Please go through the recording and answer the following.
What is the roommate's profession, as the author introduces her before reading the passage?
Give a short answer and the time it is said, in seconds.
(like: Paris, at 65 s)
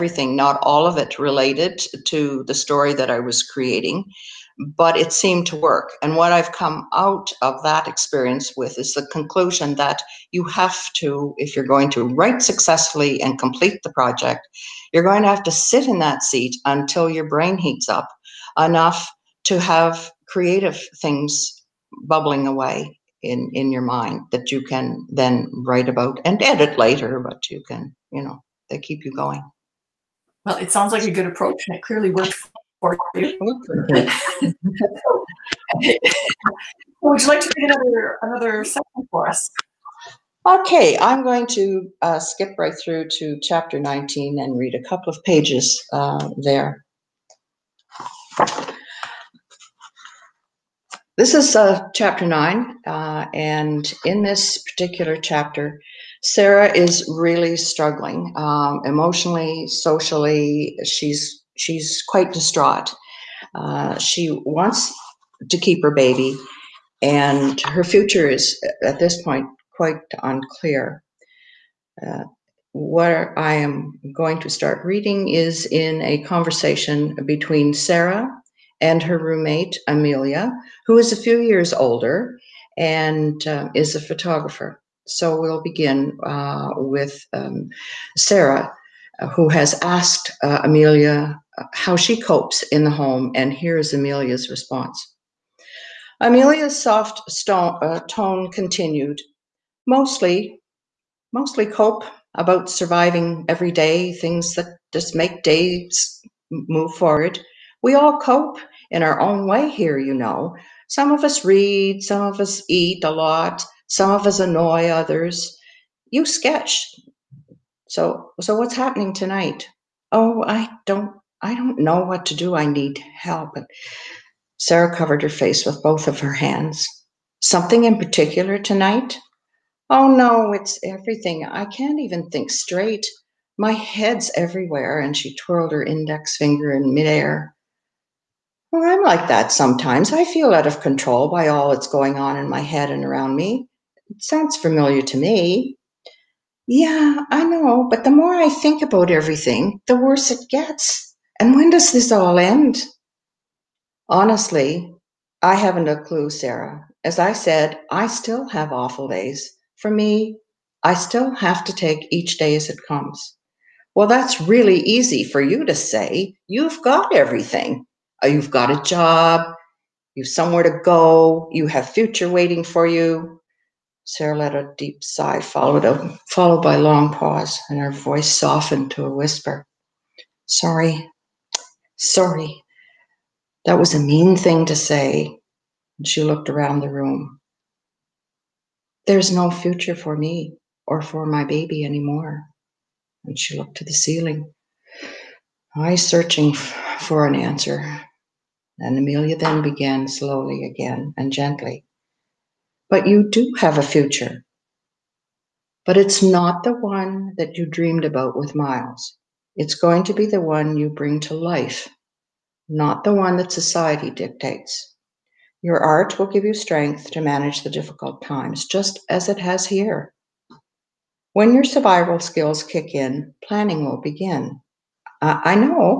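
photographer, at 84 s.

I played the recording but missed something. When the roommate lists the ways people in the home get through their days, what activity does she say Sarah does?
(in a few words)
sketch.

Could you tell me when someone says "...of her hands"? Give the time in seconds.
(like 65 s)
126 s.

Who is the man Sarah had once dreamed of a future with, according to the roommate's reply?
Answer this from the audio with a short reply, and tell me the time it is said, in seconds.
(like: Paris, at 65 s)
Miles, at 208 s.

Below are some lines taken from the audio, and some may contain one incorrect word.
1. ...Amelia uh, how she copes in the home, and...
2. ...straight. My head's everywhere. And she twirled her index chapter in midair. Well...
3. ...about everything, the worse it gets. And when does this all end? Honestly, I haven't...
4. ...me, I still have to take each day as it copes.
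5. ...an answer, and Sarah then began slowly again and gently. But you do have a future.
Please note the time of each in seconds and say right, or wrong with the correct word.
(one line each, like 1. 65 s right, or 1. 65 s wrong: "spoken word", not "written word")
1. 90 s right
2. 132 s wrong: "finger", not "chapter"
3. 148 s right
4. 159 s wrong: "comes", not "copes"
5. 197 s wrong: "Amelia", not "Sarah".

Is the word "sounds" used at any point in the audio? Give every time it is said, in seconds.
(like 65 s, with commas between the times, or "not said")
30 s, 144 s.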